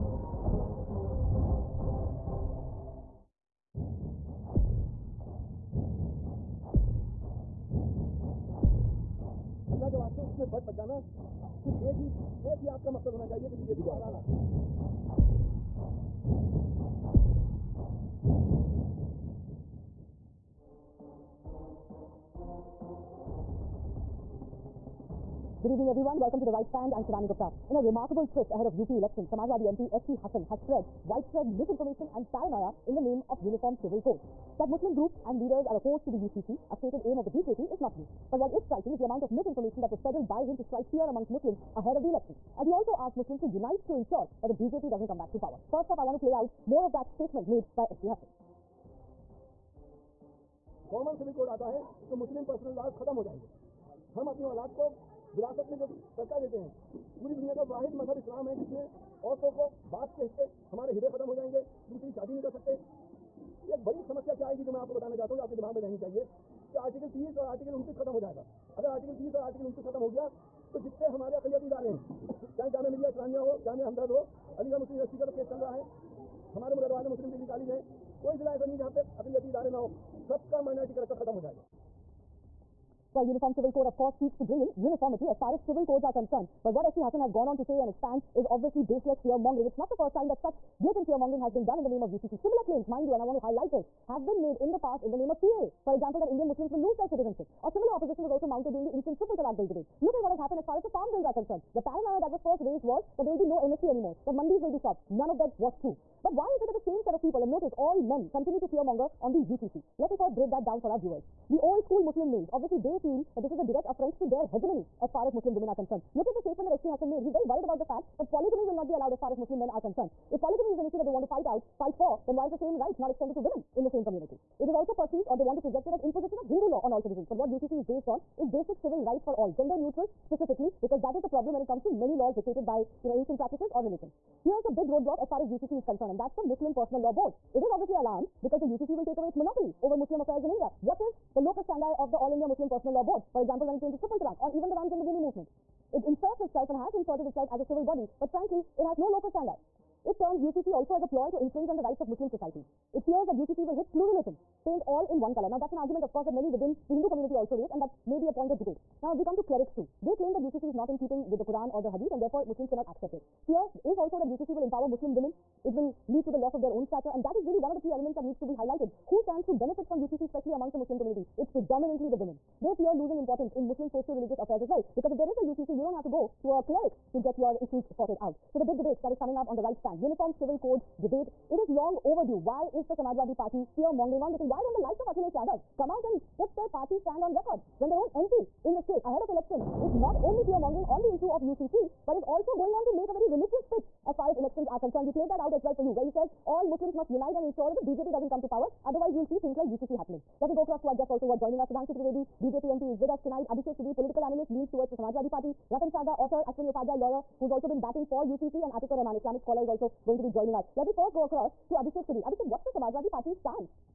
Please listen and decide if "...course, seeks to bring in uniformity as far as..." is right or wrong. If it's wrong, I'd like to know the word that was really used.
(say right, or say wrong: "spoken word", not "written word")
right.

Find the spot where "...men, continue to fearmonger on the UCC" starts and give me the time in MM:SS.
01:48.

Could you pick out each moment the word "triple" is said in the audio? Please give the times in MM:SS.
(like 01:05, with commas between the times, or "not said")
01:39, 02:23.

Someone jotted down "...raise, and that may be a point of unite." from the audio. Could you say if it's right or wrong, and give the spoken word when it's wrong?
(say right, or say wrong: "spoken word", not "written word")
wrong: "debate", not "unite".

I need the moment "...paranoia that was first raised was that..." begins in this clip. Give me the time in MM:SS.
01:41.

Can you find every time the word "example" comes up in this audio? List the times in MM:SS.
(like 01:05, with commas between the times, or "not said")
01:35, 02:23.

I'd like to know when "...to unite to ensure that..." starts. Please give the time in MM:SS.
00:43.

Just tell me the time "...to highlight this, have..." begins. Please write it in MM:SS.
01:33.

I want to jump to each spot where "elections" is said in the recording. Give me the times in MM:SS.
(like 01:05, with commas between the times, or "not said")
00:28, 00:42, 03:09, 03:14.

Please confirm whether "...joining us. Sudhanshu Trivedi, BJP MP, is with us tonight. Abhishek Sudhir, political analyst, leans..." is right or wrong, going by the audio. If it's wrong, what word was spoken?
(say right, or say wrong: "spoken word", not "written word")
right.